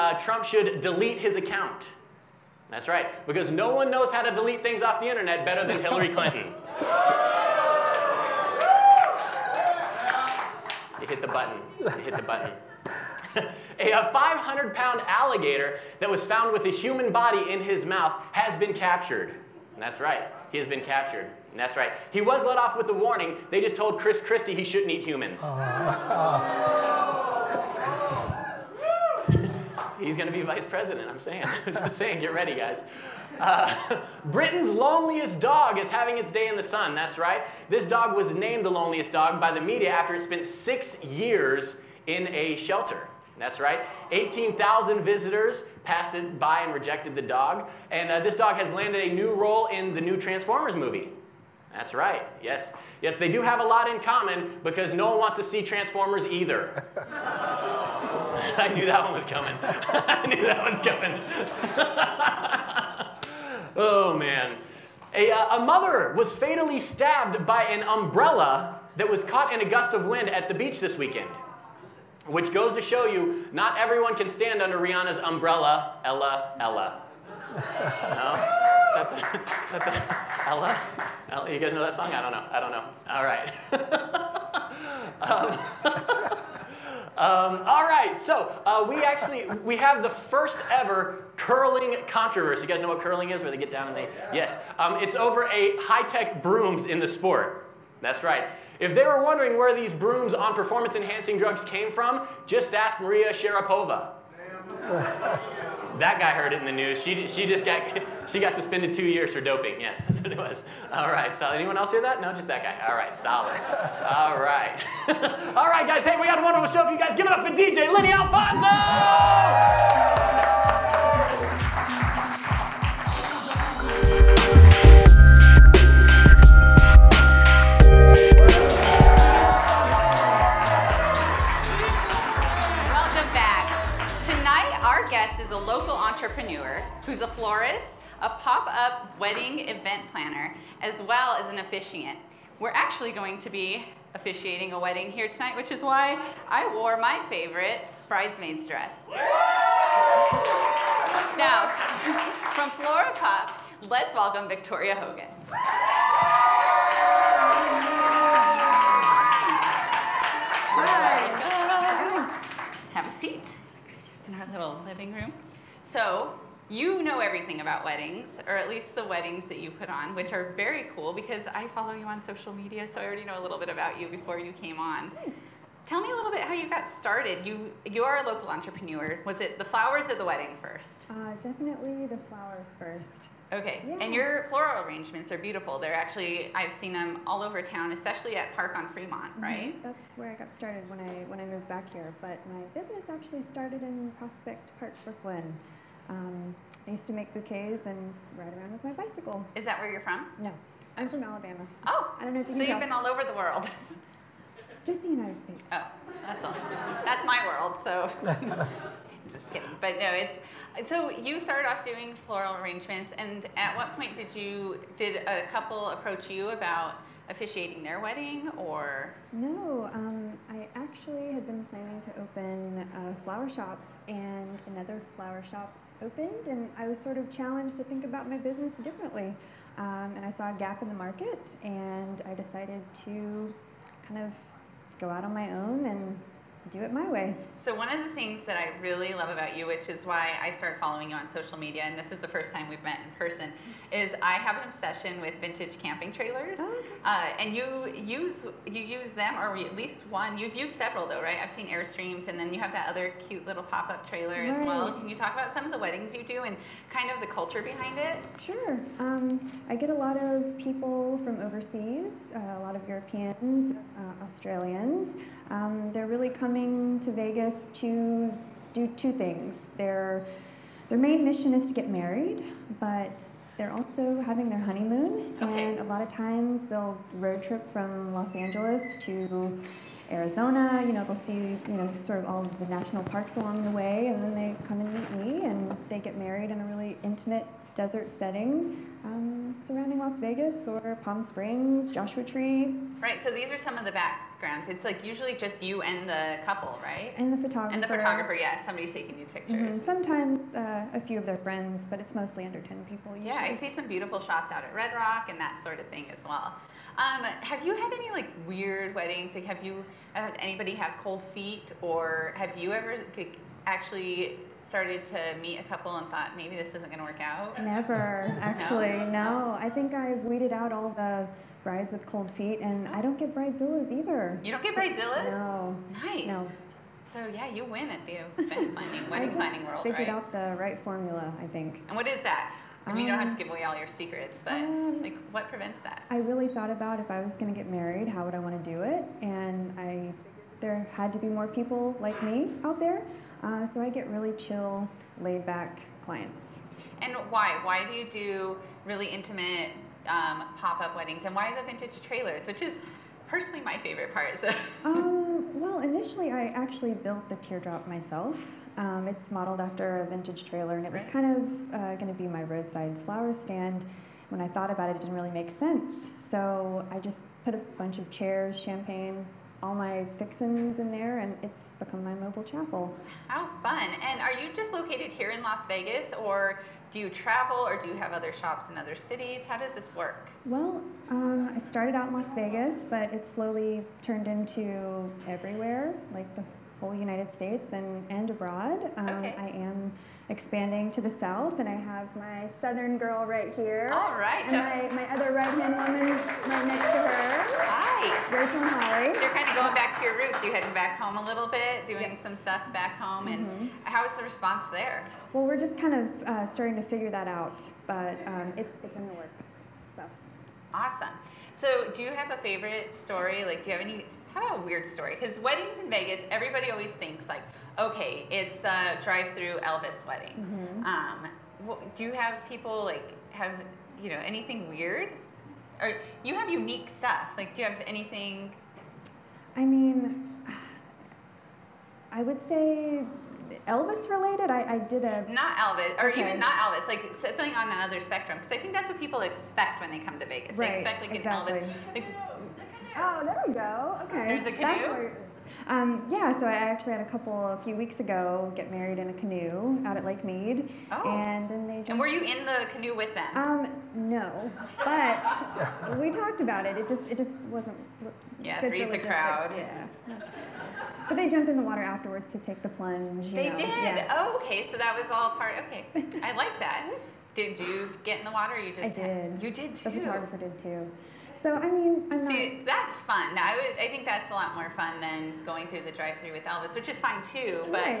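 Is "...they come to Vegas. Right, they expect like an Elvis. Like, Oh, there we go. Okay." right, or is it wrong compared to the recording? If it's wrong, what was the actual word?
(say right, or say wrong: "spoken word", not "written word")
right.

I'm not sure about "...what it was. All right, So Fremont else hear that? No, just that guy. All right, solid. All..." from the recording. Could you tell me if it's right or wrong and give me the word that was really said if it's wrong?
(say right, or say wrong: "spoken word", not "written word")
wrong: "Anyone", not "Fremont".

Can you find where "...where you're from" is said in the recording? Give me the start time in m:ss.
3:19.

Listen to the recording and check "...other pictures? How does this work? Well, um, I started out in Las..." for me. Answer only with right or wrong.
wrong.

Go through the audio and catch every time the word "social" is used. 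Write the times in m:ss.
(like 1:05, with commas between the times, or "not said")
2:52, 4:01.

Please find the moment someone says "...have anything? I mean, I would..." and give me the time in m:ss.
7:07.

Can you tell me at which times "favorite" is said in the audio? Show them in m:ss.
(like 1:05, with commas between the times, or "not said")
2:27, 5:53, 6:52.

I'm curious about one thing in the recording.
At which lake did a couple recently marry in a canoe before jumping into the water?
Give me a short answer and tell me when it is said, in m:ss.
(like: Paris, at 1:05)
Lake Mead, at 7:30.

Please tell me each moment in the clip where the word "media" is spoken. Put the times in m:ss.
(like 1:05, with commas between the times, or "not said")
0:39, 2:52, 4:01.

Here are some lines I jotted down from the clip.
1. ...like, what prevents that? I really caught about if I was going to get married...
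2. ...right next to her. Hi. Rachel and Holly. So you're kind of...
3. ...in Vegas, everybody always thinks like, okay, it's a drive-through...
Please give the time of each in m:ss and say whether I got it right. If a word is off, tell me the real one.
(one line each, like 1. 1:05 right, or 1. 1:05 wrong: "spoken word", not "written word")
1. 5:35 wrong: "thought", not "caught"
2. 6:36 right
3. 6:55 right.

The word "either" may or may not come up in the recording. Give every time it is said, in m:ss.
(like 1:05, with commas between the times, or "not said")
0:56, 5:23.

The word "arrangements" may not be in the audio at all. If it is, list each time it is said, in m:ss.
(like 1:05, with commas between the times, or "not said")
3:04, 3:32.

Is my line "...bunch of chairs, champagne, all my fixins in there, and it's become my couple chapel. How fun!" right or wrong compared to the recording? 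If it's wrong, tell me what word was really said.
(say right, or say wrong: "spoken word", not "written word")
wrong: "mobile", not "couple".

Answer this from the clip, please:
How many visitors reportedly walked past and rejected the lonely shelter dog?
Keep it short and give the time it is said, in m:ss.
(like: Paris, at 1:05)
18,000, at 0:44.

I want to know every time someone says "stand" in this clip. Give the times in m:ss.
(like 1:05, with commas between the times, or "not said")
1:14, 6:03.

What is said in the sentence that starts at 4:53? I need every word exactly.
Right, so these are some of the backgrounds.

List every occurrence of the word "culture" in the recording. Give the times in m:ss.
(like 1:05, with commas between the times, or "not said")
4:17.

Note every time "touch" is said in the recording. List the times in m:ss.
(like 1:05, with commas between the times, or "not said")
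not said.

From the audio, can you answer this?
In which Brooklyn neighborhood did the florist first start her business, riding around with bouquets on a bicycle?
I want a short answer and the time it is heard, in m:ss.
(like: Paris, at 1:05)
Prospect Park, at 3:14.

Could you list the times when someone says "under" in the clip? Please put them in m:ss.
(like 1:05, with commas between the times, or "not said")
1:14, 5:02.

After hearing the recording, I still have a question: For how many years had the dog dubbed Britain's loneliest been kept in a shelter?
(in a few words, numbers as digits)
6.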